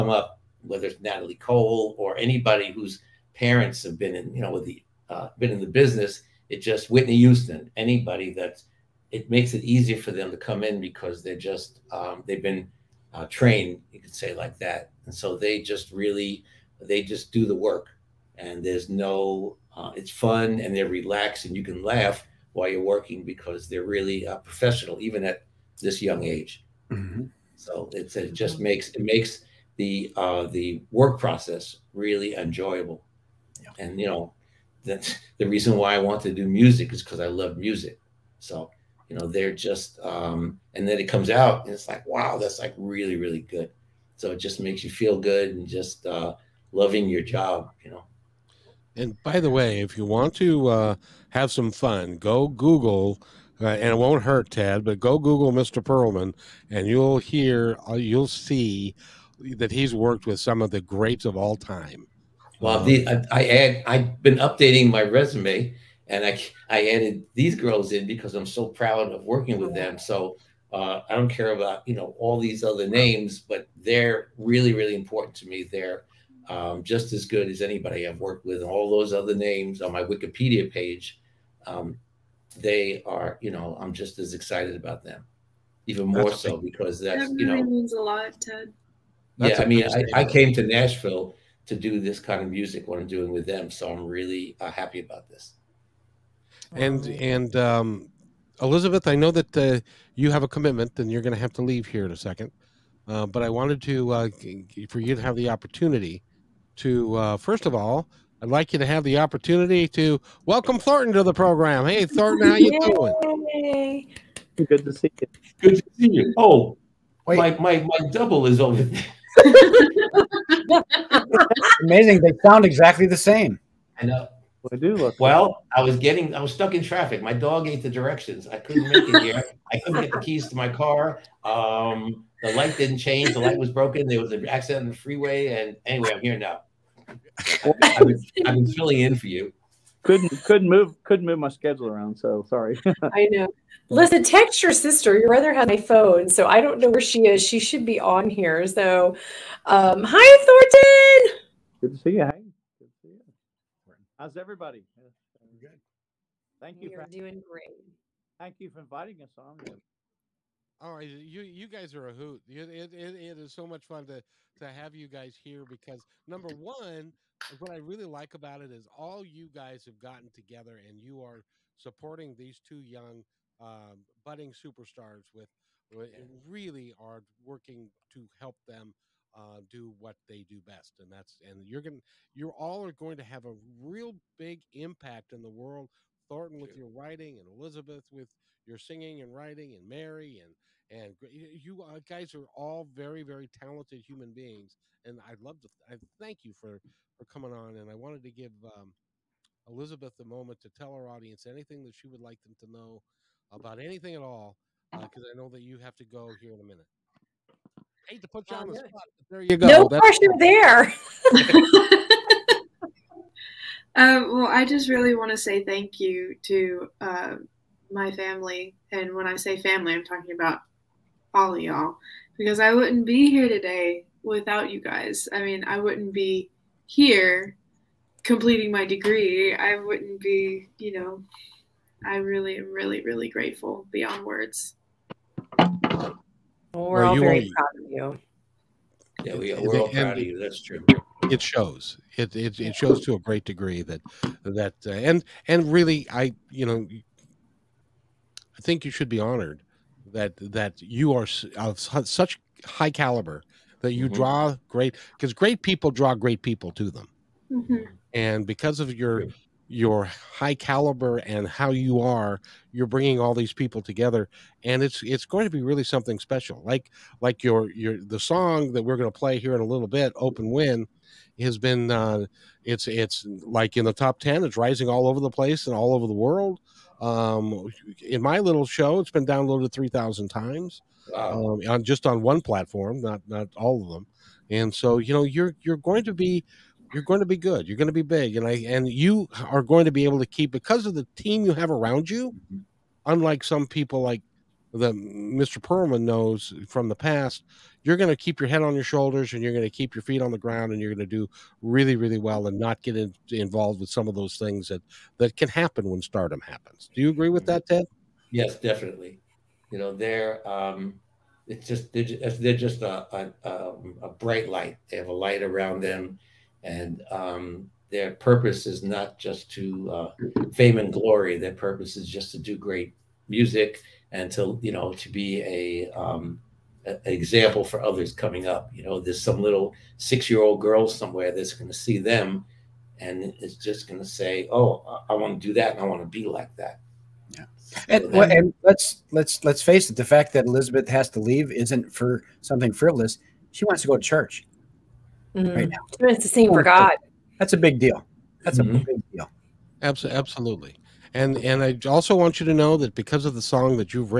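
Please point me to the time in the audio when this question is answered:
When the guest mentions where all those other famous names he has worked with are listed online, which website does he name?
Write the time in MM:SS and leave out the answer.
01:20.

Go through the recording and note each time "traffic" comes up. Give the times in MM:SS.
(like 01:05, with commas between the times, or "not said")
02:06.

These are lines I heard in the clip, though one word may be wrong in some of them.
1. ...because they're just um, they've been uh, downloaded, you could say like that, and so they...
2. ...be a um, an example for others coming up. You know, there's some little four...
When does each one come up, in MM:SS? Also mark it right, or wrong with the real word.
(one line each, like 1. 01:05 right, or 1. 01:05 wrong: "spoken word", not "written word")
1. 00:10 wrong: "trained", not "downloaded"
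2. 05:25 wrong: "six", not "four".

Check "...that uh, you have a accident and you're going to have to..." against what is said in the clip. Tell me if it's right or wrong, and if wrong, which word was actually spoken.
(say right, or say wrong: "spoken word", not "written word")
wrong: "commitment", not "accident".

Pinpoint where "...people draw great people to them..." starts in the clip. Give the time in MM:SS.
04:15.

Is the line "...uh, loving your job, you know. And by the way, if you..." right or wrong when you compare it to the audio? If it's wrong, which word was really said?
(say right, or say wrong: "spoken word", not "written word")
right.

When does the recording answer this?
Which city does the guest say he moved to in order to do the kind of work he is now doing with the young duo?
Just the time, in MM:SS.
01:30.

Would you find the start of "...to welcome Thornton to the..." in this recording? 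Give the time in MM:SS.
01:49.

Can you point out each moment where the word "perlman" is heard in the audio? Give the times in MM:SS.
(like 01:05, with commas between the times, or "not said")
00:55, 04:55.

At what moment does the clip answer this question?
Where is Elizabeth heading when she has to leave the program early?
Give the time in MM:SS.
05:44.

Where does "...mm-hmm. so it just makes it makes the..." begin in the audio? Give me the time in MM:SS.
00:26.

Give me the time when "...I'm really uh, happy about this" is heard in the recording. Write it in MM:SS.
01:33.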